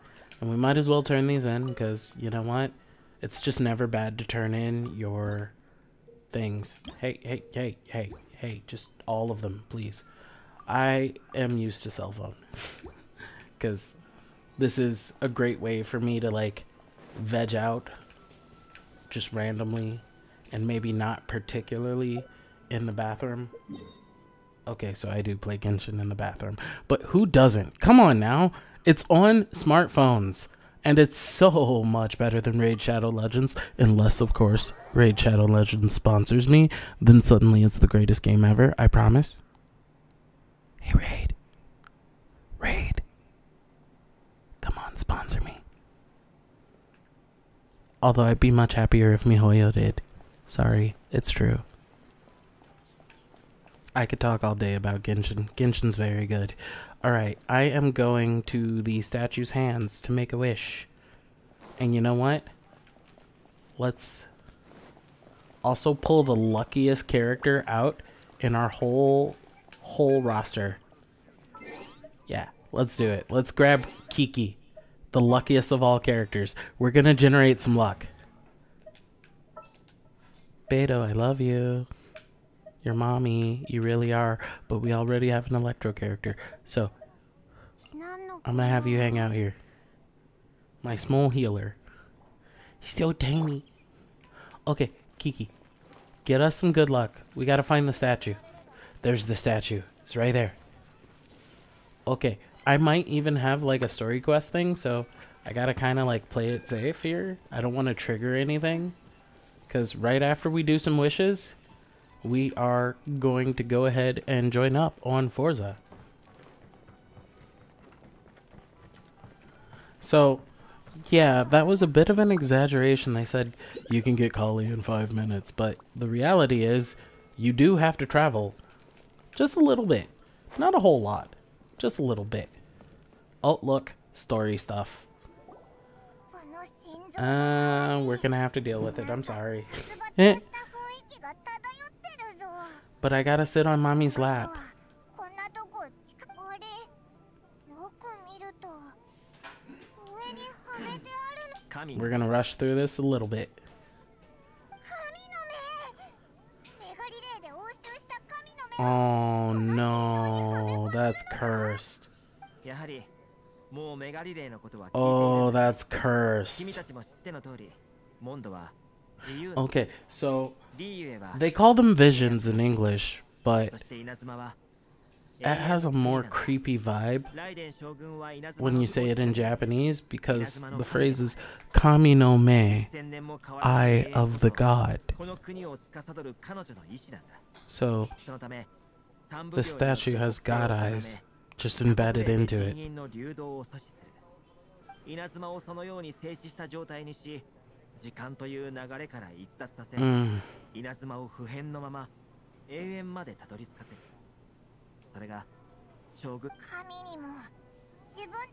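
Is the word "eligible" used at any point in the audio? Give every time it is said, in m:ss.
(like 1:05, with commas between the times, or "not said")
not said.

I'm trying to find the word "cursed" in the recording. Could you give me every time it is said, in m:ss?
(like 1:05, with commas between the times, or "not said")
2:41, 2:45.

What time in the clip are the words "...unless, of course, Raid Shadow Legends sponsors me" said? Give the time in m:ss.
0:33.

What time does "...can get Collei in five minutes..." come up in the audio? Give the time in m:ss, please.
2:04.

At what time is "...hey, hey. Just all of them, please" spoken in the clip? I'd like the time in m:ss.
0:07.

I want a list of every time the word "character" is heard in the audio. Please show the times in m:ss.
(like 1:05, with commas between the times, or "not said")
1:07, 1:15, 1:25.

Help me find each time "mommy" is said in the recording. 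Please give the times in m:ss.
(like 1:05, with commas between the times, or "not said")
1:22, 2:23.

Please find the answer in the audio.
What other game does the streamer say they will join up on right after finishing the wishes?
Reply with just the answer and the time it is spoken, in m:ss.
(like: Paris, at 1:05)
Forza, at 1:55.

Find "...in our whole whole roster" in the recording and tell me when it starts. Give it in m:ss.
1:08.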